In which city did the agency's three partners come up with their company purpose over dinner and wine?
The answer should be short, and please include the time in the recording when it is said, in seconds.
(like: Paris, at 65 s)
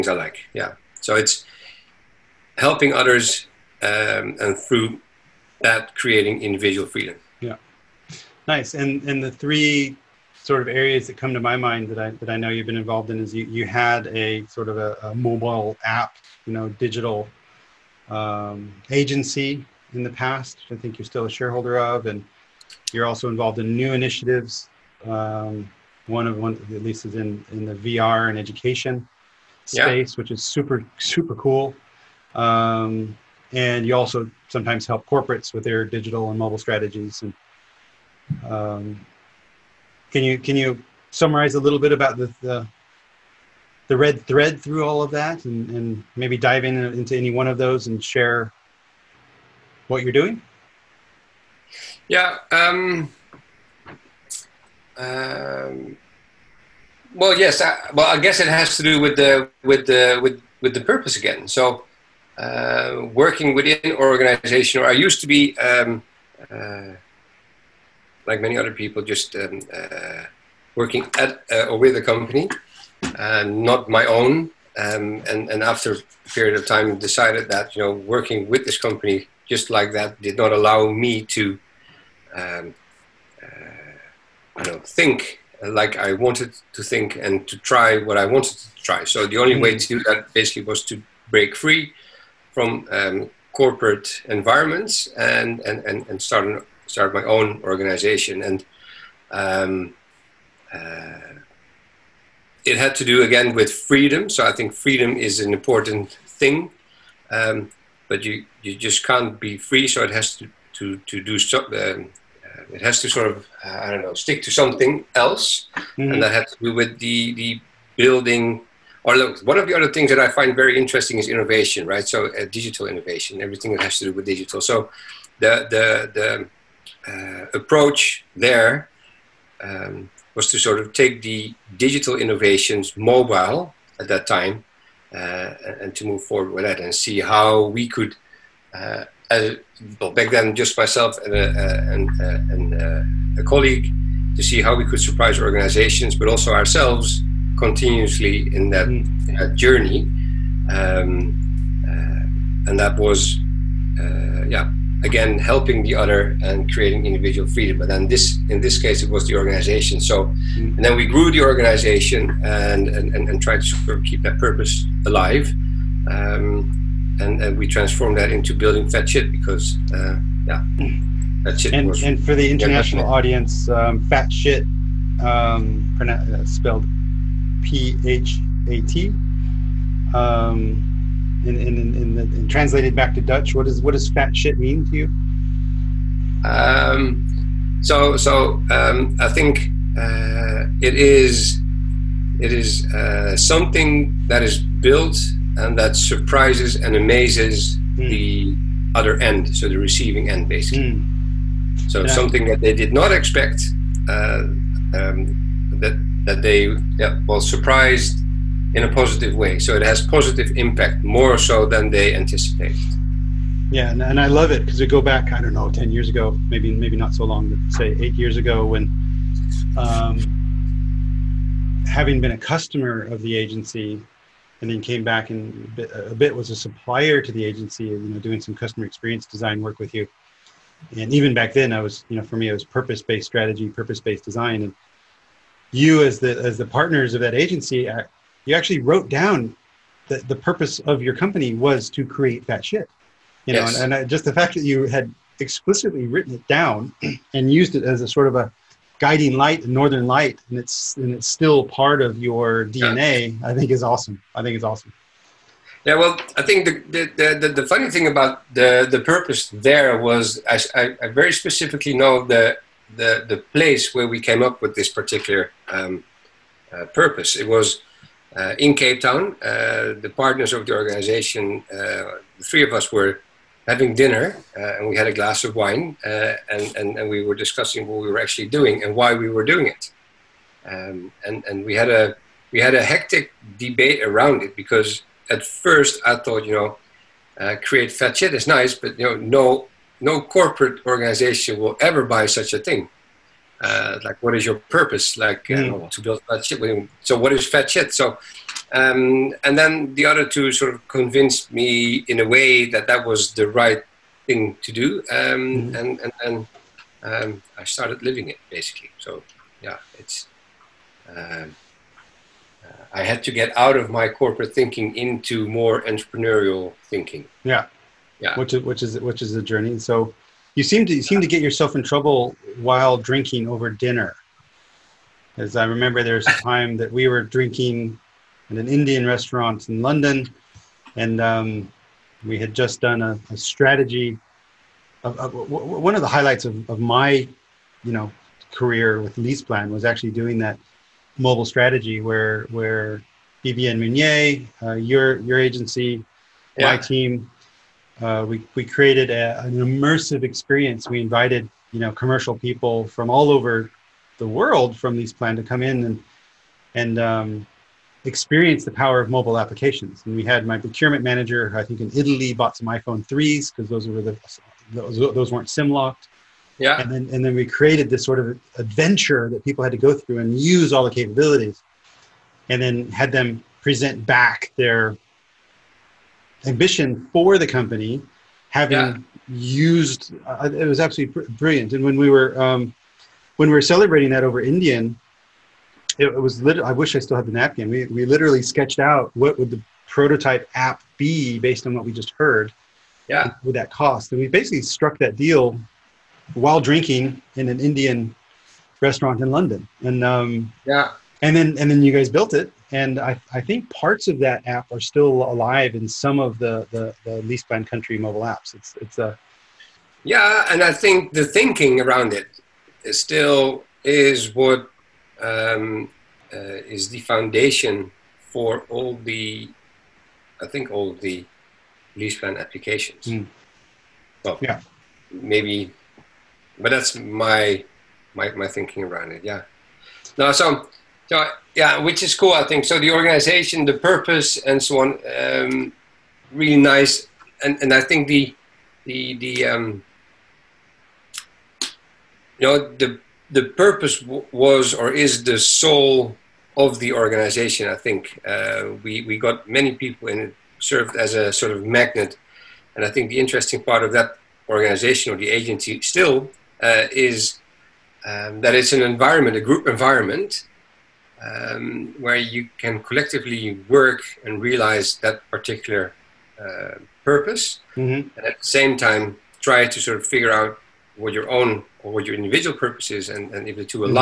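Cape Town, at 268 s.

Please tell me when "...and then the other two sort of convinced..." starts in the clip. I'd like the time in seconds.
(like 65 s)
299 s.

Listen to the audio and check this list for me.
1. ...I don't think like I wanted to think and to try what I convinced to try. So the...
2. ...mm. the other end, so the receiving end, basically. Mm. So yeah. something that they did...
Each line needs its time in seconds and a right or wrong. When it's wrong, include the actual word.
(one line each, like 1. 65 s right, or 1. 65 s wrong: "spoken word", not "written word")
1. 84 s wrong: "wanted", not "convinced"
2. 197 s right.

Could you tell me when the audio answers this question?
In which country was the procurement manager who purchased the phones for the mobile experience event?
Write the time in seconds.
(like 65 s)
361 s.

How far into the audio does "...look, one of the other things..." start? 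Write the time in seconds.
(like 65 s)
119 s.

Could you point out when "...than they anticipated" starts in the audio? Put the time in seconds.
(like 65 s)
211 s.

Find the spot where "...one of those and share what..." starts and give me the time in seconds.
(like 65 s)
47 s.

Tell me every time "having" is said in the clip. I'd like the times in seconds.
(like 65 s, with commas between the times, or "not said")
221 s, 273 s, 378 s.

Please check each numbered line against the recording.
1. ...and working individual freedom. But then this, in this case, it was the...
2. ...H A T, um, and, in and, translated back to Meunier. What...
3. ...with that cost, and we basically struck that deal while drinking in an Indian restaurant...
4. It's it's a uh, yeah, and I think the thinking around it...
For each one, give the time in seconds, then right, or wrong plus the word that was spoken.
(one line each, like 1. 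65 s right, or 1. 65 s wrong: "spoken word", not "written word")
1. 156 s wrong: "creating", not "working"
2. 178 s wrong: "Dutch", not "Meunier"
3. 393 s right
4. 408 s right.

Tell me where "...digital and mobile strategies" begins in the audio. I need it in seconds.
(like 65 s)
35 s.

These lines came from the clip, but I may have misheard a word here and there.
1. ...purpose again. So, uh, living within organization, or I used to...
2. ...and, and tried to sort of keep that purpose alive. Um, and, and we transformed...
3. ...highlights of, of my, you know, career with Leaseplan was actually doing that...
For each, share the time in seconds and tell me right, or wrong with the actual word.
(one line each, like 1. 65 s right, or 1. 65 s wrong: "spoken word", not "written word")
1. 60 s wrong: "working", not "living"
2. 163 s right
3. 336 s right.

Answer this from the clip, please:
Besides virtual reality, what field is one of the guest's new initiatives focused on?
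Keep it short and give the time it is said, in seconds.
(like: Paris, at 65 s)
education, at 28 s.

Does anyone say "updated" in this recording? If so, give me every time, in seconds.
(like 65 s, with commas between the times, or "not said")
not said.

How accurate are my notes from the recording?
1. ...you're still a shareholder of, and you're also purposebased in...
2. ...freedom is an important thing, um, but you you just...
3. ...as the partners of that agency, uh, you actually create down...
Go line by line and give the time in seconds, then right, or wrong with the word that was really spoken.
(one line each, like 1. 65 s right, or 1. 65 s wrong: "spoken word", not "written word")
1. 20 s wrong: "involved", not "purposebased"
2. 104 s right
3. 236 s wrong: "wrote", not "create".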